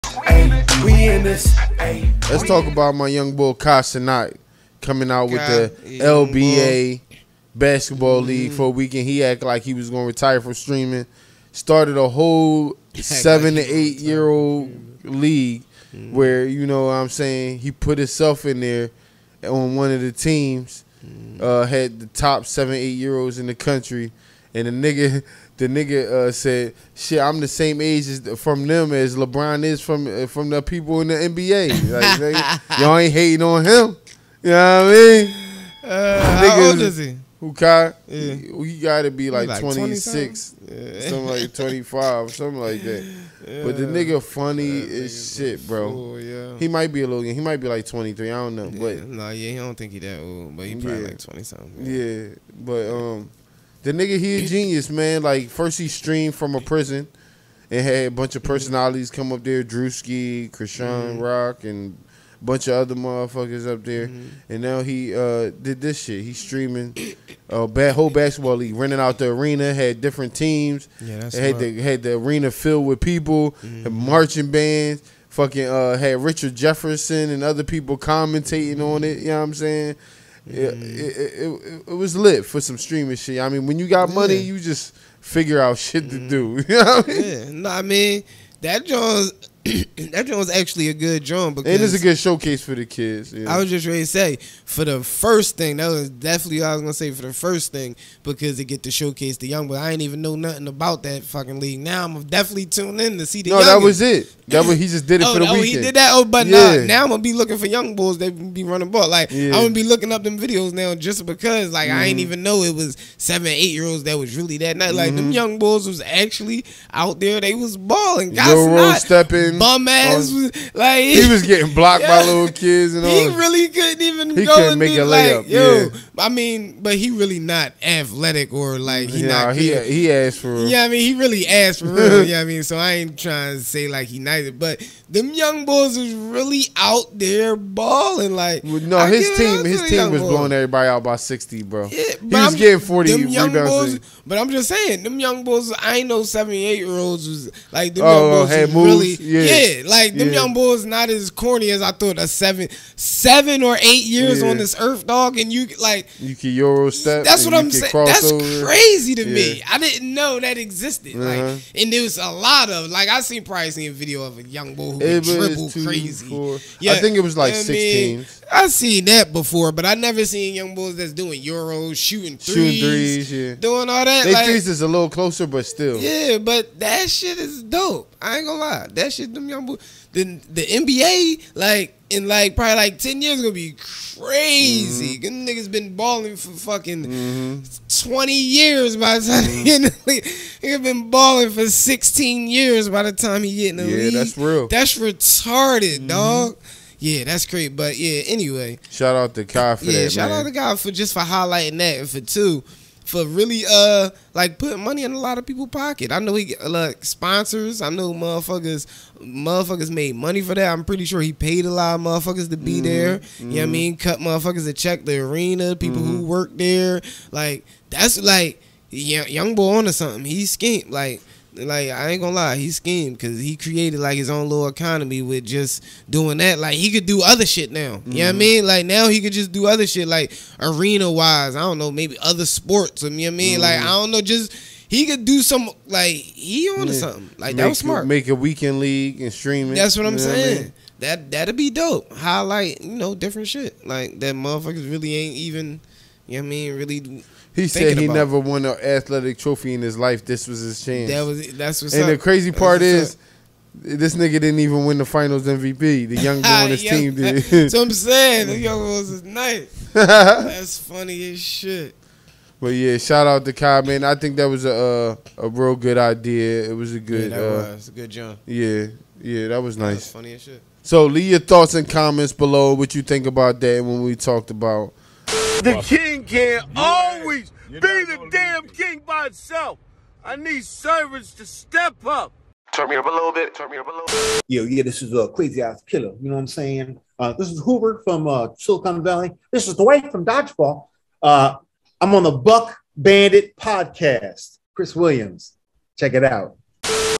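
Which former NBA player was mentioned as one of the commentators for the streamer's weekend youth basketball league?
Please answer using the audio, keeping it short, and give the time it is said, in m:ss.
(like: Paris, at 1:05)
Richard Jefferson, at 1:16.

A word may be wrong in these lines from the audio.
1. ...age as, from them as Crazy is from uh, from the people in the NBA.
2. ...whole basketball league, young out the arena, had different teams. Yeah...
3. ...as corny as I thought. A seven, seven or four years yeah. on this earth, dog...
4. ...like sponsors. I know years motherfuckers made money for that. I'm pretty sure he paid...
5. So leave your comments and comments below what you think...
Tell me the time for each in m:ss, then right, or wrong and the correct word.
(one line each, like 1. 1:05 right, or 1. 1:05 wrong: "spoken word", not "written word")
1. 0:27 wrong: "LeBron", not "Crazy"
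2. 1:07 wrong: "renting", not "young"
3. 2:31 wrong: "eight", not "four"
4. 3:26 wrong: "motherfuckers", not "years"
5. 4:30 wrong: "thoughts", not "comments".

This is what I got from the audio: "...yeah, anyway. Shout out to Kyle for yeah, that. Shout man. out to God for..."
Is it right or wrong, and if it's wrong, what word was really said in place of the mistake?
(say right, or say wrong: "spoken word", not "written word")
wrong: "Kai", not "Kyle".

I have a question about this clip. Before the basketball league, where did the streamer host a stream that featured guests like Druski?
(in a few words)
a prison.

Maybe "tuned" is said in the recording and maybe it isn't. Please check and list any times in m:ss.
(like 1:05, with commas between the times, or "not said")
1:42.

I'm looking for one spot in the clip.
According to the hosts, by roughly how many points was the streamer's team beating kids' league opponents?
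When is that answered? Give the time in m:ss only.
2:21.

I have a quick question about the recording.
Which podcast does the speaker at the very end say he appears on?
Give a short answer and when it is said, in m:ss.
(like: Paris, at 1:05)
Buck Bandit podcast, at 4:52.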